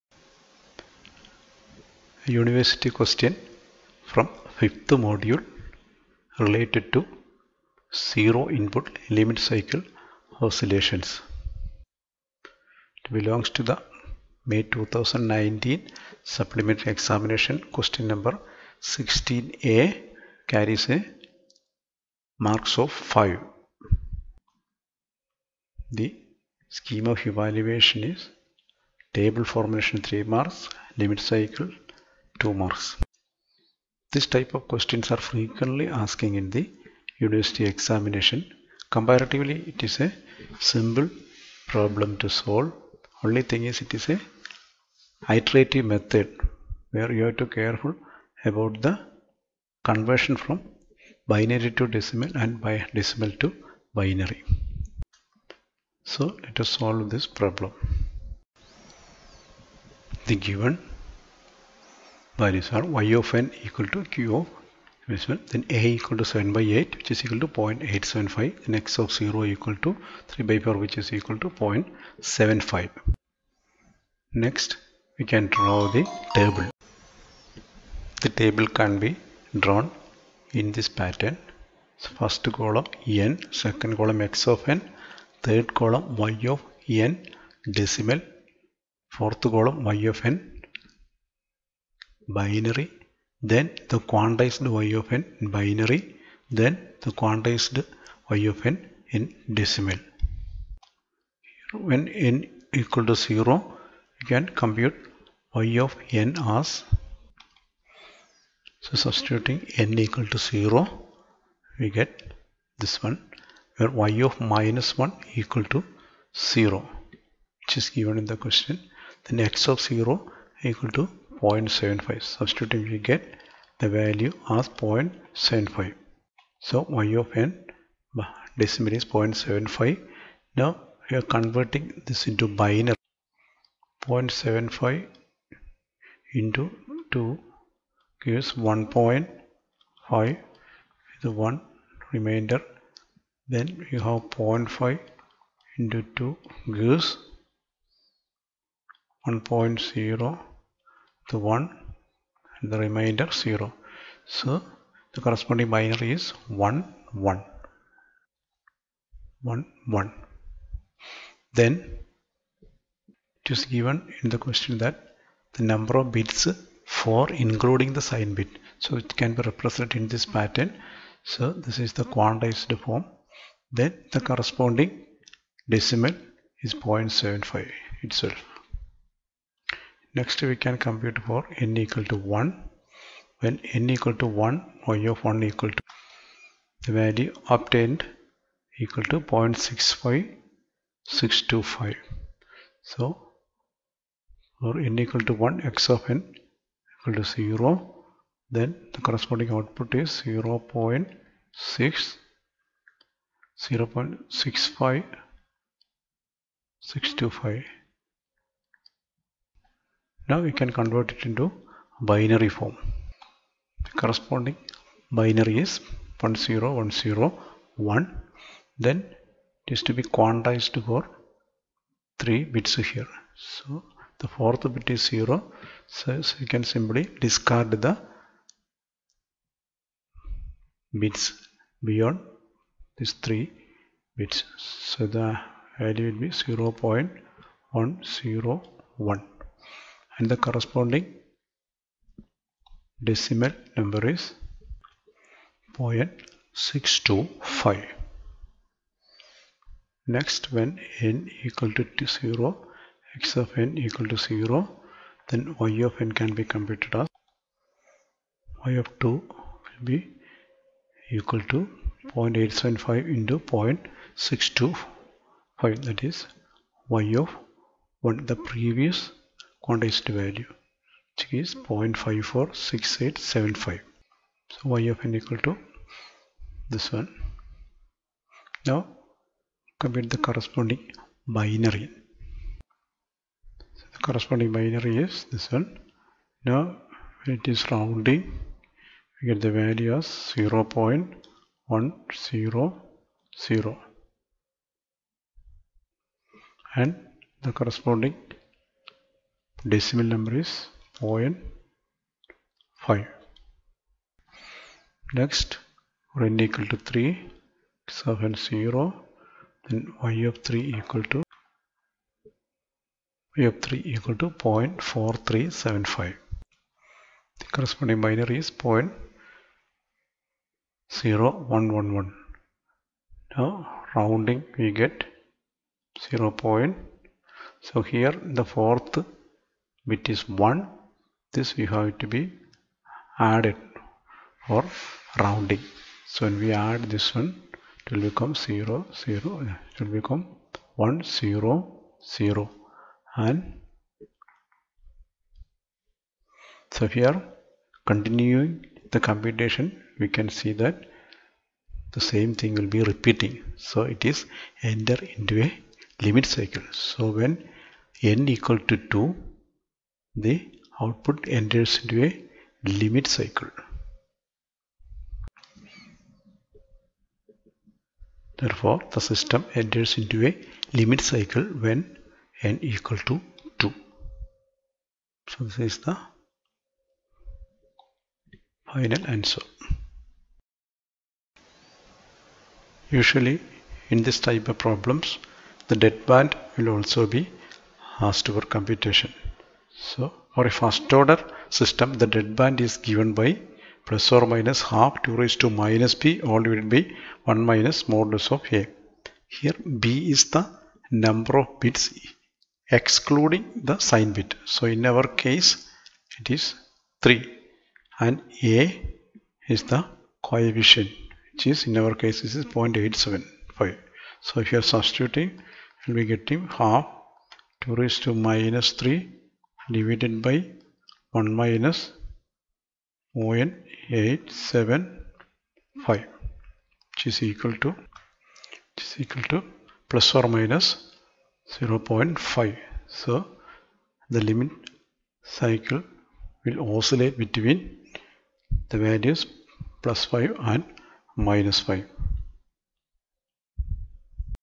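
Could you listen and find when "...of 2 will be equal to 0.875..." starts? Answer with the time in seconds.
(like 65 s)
258 s.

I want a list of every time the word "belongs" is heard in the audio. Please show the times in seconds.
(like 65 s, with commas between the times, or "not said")
13 s.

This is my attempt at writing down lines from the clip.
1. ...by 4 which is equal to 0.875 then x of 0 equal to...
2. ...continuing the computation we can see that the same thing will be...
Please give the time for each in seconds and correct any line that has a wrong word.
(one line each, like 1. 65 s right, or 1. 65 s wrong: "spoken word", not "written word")
1. 66 s wrong: "8", not "4"
2. 347 s right.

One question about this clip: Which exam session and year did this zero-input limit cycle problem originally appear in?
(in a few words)
May 2019 supplementary.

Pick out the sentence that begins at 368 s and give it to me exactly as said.
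Therefore, the system enters into a limit cycle when n equal to 2.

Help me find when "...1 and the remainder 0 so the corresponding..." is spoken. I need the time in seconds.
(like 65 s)
151 s.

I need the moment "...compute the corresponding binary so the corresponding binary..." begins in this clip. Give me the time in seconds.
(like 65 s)
279 s.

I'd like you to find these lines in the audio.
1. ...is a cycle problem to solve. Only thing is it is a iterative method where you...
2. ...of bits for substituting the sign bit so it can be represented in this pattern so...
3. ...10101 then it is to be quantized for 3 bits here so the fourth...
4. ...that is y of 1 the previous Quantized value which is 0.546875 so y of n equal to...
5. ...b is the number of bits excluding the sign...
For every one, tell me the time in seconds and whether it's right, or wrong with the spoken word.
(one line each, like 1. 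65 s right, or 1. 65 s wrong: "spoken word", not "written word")
1. 39 s wrong: "simple", not "cycle"
2. 166 s wrong: "including", not "substituting"
3. 216 s right
4. 265 s right
5. 399 s right.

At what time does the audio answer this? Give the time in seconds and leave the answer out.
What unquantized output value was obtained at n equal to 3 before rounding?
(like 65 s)
314 s.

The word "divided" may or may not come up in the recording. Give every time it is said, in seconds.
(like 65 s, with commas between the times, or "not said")
396 s, 419 s.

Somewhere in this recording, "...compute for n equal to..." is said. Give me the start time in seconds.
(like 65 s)
180 s.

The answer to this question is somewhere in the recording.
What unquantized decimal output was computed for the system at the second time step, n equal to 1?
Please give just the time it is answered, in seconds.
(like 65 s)
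189 s.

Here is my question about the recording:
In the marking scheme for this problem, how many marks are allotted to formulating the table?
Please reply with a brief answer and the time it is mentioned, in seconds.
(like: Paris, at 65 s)
3 marks, at 30 s.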